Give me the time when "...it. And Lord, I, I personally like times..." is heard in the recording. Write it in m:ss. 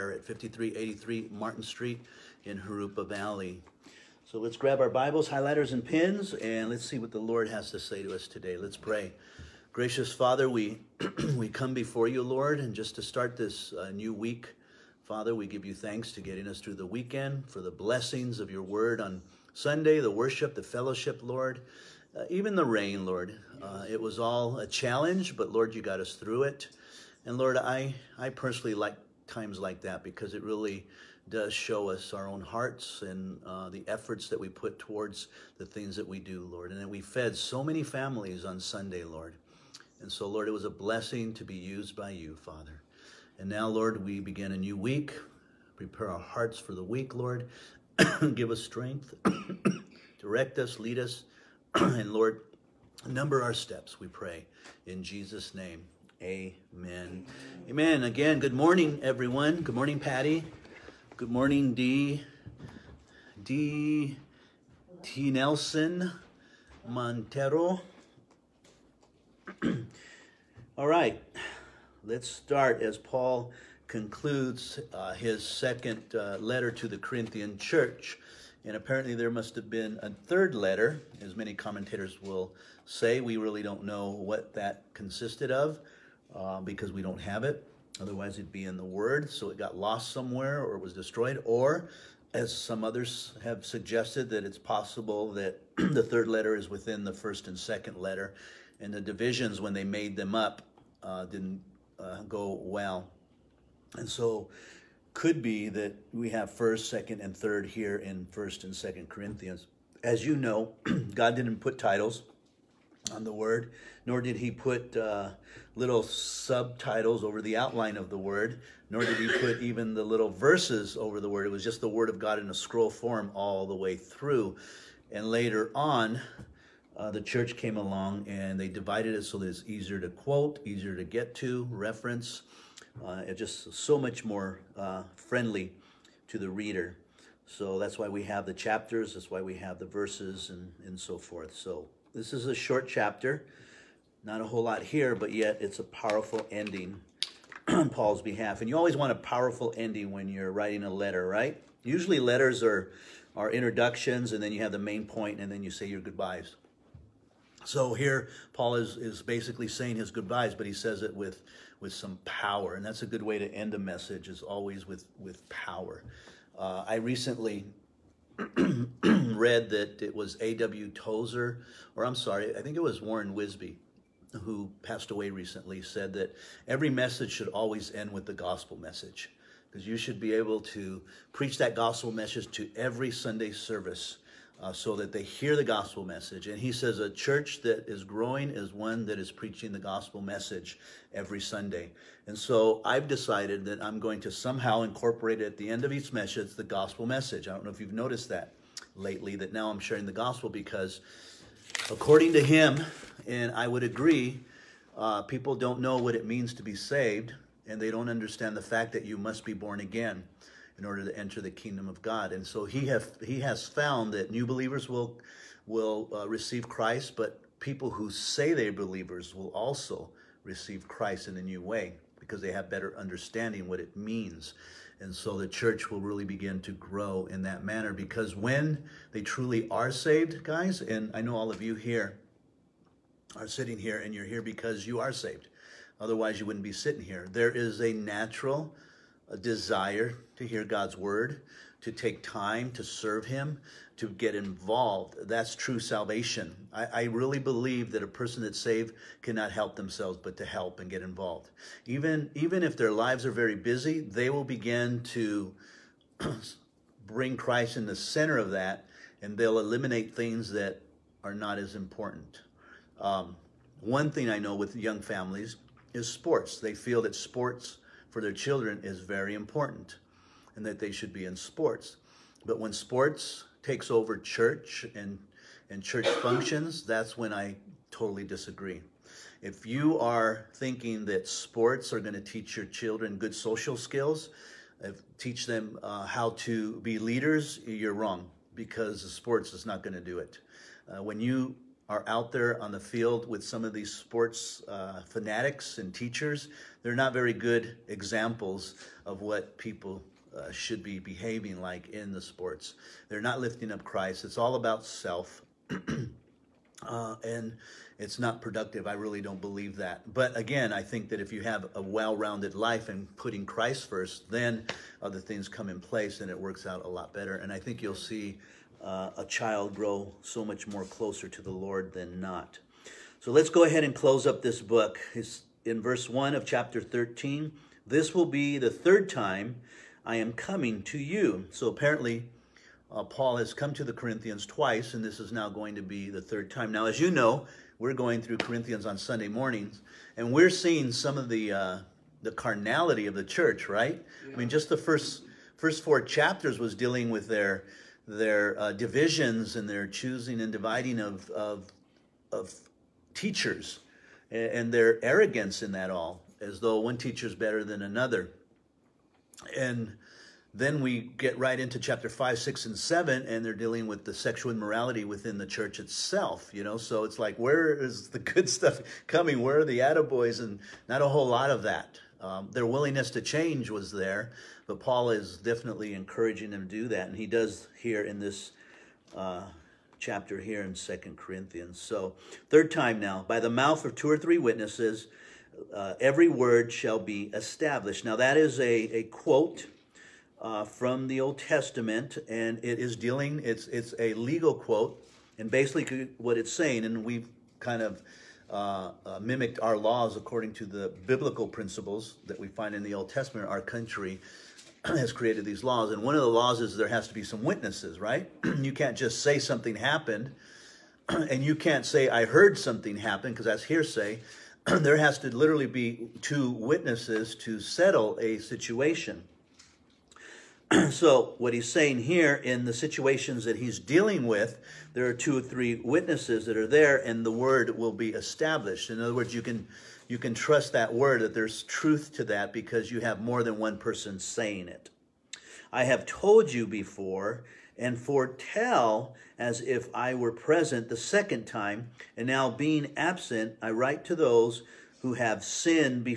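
0:26.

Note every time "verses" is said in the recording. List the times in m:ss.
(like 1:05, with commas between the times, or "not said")
2:00, 2:19, 5:25.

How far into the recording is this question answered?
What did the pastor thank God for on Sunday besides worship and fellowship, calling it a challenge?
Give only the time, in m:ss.
0:22.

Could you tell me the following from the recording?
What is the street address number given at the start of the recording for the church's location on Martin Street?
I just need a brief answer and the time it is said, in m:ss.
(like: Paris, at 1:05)
5383, at 0:00.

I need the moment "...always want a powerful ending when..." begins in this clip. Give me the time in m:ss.
2:28.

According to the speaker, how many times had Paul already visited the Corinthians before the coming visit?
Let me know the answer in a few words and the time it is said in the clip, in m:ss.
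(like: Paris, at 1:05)
2, at 5:34.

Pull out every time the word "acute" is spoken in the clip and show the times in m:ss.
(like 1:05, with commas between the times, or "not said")
not said.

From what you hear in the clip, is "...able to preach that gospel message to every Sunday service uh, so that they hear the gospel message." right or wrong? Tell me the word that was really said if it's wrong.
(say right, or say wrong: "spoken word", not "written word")
right.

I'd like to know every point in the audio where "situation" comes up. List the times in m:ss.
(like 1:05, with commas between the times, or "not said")
6:58, 7:02.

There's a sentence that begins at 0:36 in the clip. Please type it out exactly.
And that we fed so many families on Sunday, Lord.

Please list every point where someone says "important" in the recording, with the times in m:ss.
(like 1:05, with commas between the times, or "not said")
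4:21, 4:29.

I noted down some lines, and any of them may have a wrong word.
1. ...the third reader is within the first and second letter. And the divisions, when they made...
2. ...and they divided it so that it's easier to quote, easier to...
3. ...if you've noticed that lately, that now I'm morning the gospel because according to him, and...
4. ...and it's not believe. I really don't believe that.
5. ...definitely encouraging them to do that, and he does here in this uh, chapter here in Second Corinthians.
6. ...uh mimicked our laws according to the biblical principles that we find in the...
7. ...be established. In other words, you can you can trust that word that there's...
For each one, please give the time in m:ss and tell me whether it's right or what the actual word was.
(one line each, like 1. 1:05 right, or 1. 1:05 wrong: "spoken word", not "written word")
1. 1:35 wrong: "letter", not "reader"
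2. 2:08 right
3. 3:17 wrong: "sharing", not "morning"
4. 5:07 wrong: "productive", not "believe"
5. 6:15 right
6. 6:39 right
7. 7:07 right.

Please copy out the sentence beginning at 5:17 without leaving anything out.
And I think you'll see uh, a child grow so much more closer to the Lord than not.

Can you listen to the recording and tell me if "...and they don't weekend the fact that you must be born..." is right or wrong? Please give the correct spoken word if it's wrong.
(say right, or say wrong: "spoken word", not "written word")
wrong: "understand", not "weekend".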